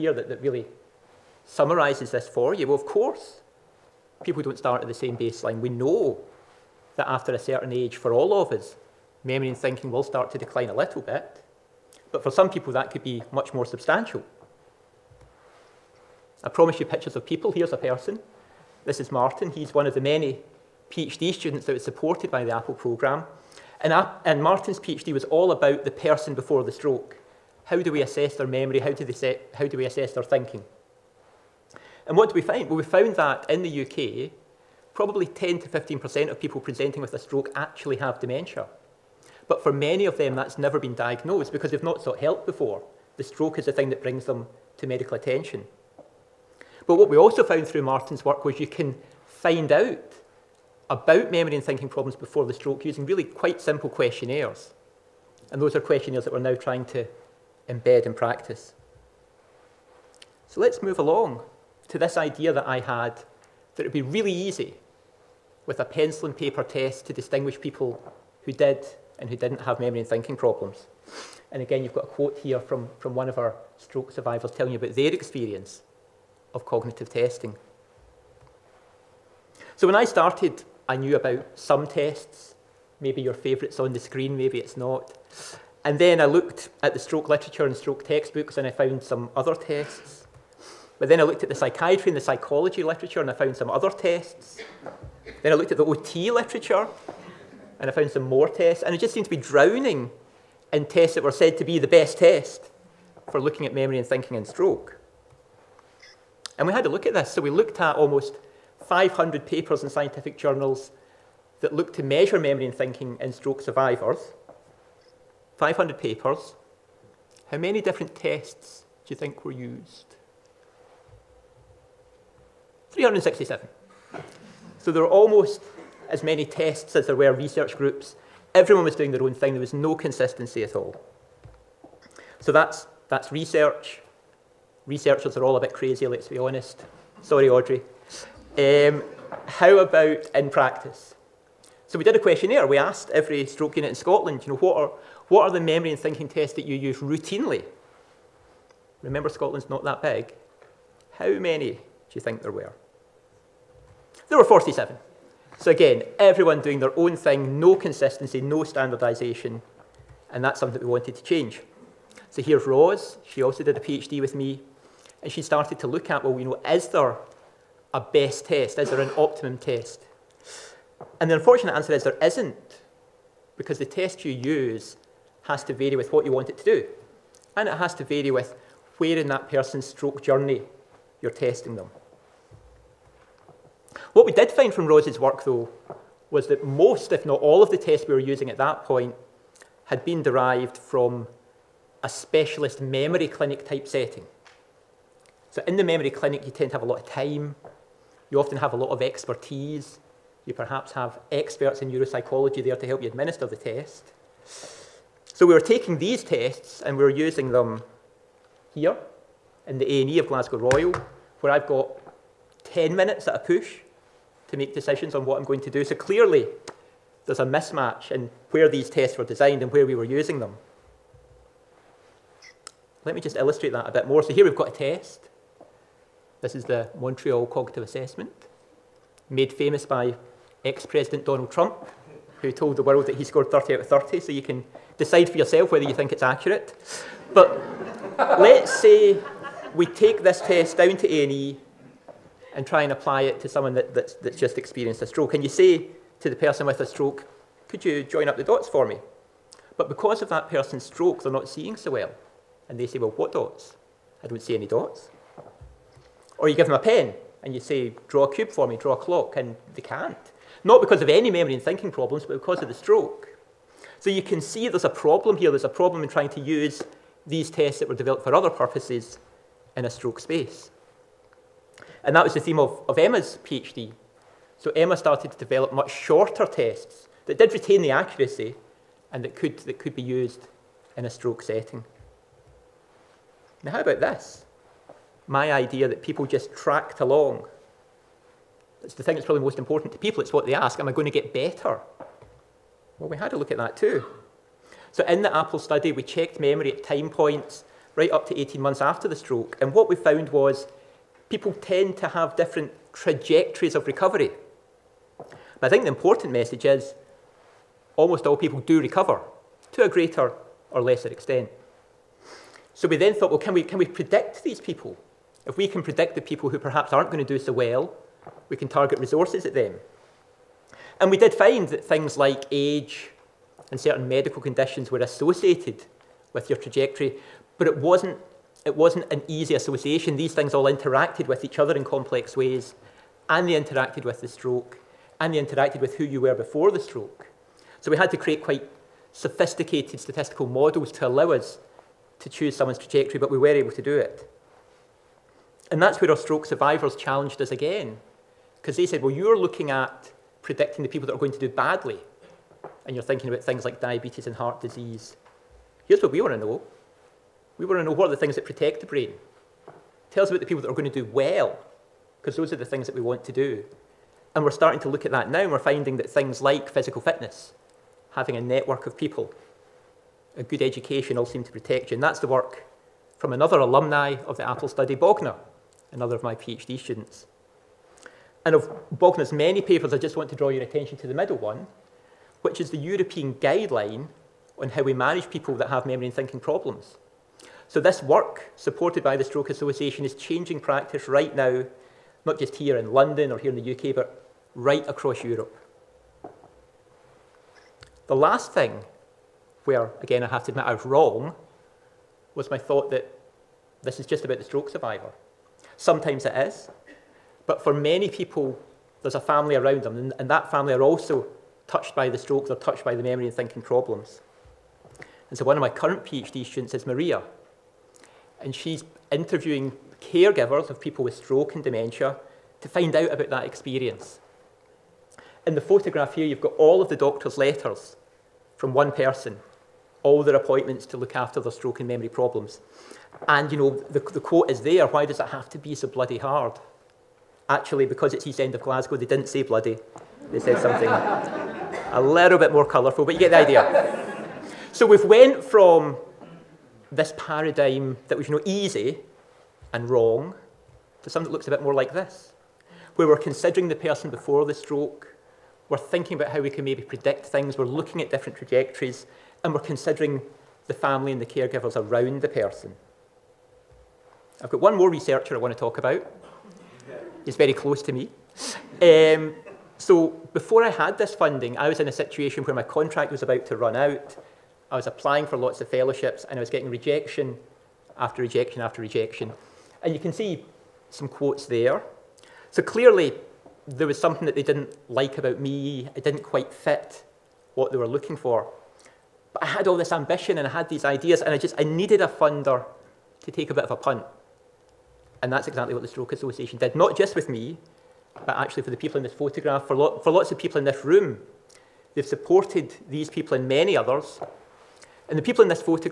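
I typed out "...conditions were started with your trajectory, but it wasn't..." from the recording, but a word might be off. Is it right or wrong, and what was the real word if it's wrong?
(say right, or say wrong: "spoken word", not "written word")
wrong: "associated", not "started".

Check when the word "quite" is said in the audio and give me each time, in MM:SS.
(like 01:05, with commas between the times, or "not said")
00:53, 05:38, 08:06.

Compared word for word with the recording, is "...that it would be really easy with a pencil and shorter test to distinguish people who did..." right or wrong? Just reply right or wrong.
wrong.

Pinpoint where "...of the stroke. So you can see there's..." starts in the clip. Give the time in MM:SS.
04:22.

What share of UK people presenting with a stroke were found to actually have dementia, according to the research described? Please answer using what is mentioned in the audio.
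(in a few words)
10 to 15%.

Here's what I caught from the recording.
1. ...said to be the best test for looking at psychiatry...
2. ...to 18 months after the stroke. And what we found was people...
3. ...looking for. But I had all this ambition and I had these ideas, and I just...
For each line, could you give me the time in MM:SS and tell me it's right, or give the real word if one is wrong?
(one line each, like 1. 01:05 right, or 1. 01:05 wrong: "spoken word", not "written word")
1. 01:41 wrong: "memory", not "psychiatry"
2. 04:58 right
3. 08:07 right.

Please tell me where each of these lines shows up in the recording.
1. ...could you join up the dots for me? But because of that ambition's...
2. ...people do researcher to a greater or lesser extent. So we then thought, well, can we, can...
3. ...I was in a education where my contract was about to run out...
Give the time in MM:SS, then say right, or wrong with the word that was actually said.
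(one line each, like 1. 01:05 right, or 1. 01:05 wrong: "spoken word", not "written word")
1. 04:07 wrong: "person", not "ambition"
2. 05:08 wrong: "recover", not "researcher"
3. 07:51 wrong: "situation", not "education".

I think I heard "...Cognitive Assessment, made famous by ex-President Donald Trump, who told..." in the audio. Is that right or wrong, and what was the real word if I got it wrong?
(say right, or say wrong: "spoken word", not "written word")
right.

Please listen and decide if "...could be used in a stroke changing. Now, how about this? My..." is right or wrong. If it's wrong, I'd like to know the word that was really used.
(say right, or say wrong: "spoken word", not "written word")
wrong: "setting", not "changing".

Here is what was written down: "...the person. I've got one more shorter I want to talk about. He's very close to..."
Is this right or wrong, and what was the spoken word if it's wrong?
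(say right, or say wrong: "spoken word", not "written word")
wrong: "researcher", not "shorter".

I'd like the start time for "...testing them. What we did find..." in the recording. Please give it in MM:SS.
03:01.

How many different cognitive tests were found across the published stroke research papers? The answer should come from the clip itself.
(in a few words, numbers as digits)
367.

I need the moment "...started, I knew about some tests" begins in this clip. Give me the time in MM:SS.
01:20.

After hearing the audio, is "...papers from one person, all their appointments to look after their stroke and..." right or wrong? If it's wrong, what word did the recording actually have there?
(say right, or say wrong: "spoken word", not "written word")
wrong: "letters", not "papers".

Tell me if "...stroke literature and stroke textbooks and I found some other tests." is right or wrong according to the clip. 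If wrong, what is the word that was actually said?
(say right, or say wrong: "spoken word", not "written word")
right.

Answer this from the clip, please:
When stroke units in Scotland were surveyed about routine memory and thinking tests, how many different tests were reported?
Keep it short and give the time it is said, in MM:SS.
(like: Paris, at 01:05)
47, at 02:34.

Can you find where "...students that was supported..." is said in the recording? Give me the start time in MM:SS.
00:21.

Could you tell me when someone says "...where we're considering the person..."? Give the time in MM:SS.
07:32.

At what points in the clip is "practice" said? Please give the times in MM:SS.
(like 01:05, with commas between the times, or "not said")
00:58, 02:20, 06:30.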